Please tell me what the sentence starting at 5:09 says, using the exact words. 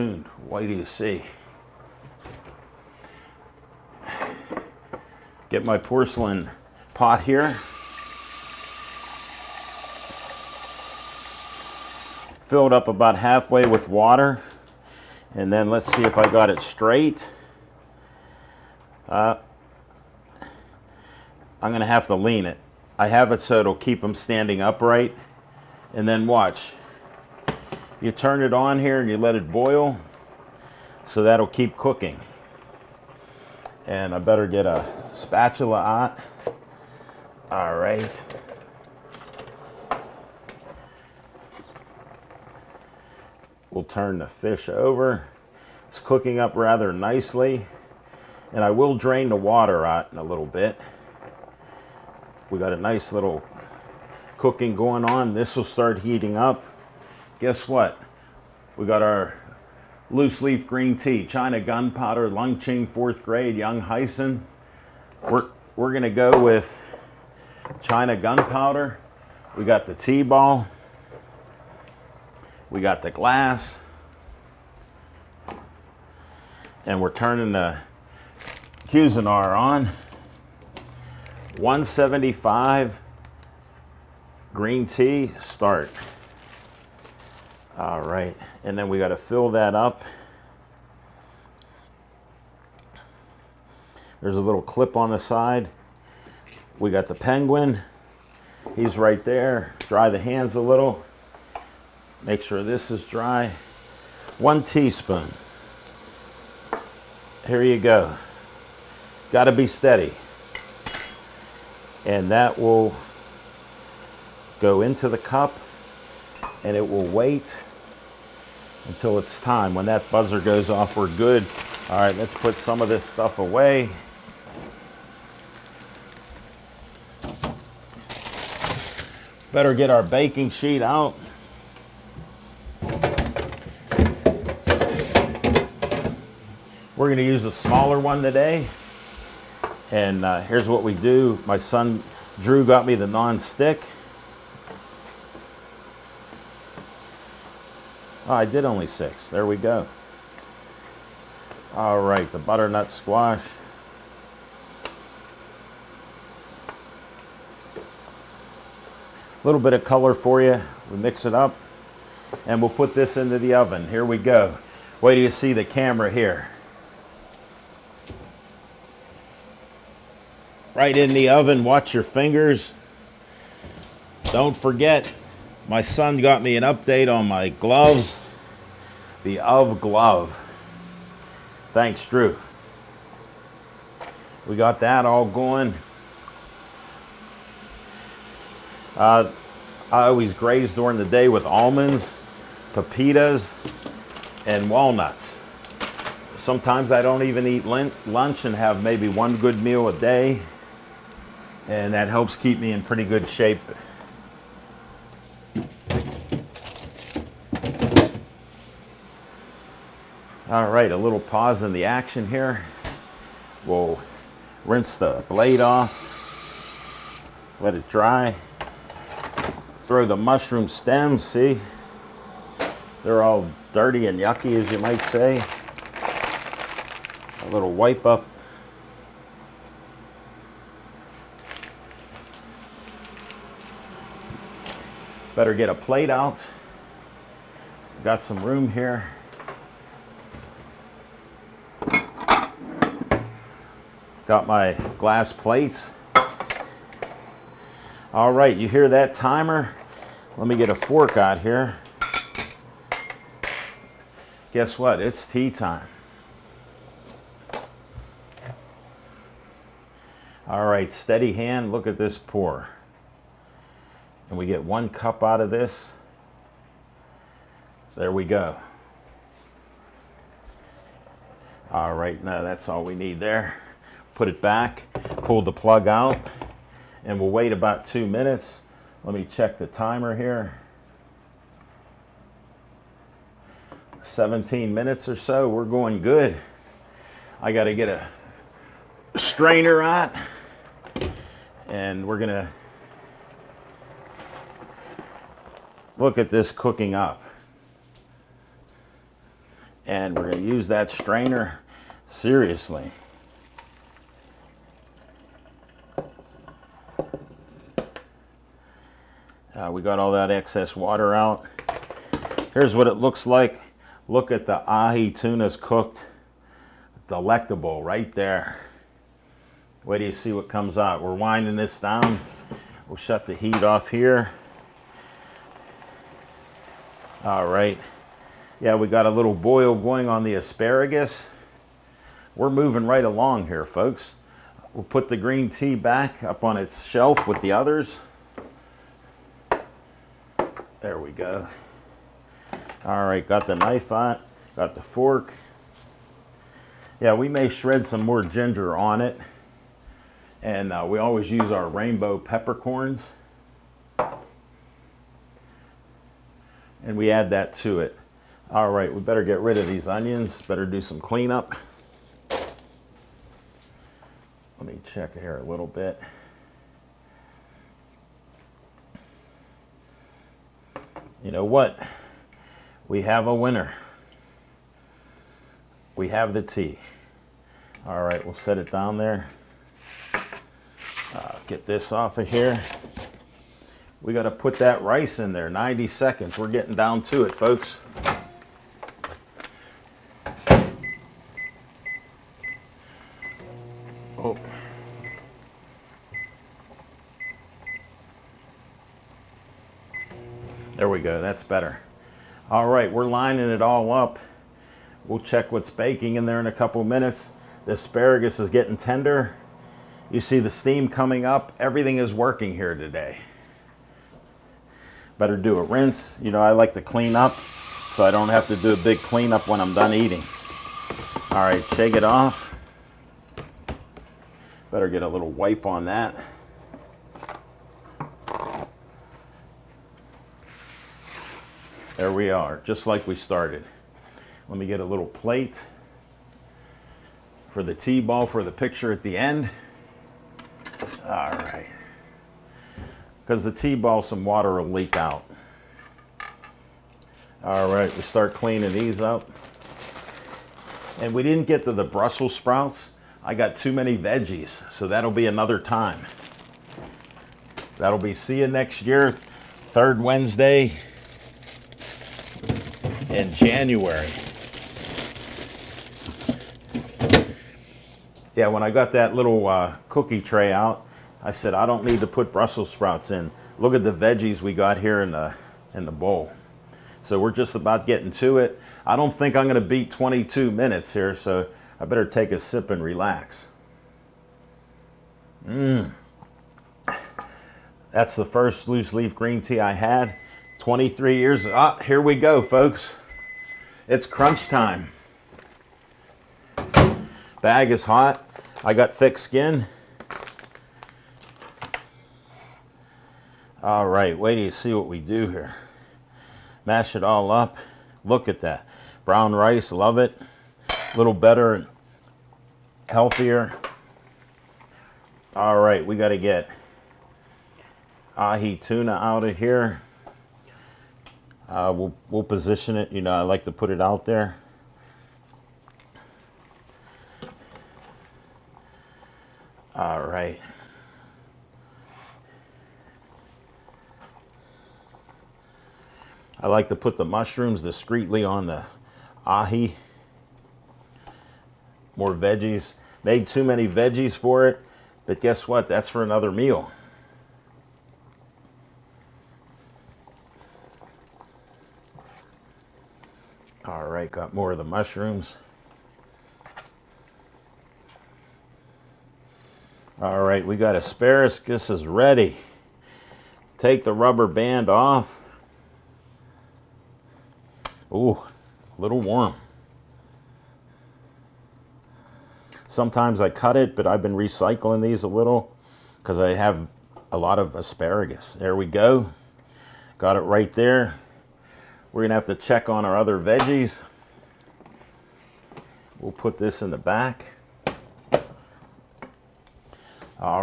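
Uh, we got all that excess water out.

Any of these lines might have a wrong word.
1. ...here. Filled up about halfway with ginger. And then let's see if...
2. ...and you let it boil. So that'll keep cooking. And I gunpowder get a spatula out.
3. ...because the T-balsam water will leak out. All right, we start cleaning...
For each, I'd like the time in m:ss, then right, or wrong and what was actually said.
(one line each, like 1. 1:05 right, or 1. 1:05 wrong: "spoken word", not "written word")
1. 0:07 wrong: "water", not "ginger"
2. 0:29 wrong: "better", not "gunpowder"
3. 7:23 right.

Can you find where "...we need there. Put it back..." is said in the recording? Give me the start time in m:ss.
4:32.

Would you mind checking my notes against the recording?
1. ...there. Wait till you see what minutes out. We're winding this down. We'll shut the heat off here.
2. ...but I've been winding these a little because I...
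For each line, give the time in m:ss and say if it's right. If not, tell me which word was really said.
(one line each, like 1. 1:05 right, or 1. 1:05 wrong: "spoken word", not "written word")
1. 5:18 wrong: "comes", not "minutes"
2. 9:33 wrong: "recycling", not "winding".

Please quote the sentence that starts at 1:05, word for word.
We're, we're gonna go with China gunpowder.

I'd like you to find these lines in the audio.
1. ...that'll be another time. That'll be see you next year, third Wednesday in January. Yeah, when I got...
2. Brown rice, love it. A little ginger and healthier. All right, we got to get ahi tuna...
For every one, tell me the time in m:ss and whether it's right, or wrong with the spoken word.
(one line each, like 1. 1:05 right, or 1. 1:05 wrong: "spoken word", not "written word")
1. 7:34 right
2. 8:29 wrong: "better", not "ginger".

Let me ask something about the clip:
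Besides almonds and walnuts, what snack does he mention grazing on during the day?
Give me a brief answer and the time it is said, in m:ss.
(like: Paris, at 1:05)
pepitas, at 3:11.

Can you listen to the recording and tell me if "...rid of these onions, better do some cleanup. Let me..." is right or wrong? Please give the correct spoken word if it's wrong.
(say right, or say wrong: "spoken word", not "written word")
right.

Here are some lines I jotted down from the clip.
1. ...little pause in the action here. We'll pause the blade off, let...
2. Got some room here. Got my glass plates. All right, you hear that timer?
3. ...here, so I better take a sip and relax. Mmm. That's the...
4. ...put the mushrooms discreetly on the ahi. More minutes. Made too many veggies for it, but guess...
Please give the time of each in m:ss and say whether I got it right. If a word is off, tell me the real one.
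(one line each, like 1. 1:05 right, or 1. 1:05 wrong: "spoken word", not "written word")
1. 3:30 wrong: "rinse", not "pause"
2. 3:58 right
3. 8:00 right
4. 8:56 wrong: "veggies", not "minutes".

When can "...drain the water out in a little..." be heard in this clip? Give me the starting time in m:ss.
0:48.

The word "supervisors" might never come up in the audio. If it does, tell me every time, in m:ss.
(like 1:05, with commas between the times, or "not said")
not said.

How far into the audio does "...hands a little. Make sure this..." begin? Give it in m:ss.
1:40.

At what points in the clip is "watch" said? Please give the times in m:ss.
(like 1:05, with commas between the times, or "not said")
0:26, 2:51.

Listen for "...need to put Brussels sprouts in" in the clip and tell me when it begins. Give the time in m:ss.
7:51.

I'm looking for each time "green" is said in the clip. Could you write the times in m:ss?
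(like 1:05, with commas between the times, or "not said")
1:00, 1:24, 5:35, 8:09.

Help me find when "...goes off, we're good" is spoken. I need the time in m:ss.
2:00.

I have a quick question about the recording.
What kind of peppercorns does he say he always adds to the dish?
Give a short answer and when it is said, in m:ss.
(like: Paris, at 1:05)
rainbow peppercorns, at 5:51.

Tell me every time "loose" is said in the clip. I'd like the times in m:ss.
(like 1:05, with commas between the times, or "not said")
1:00, 8:08.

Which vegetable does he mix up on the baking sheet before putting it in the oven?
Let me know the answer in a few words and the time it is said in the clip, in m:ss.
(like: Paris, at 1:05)
butternut squash, at 2:32.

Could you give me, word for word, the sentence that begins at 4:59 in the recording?
And we're going to use that strainer seriously.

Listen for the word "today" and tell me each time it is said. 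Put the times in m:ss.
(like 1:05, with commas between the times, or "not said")
2:18, 6:52.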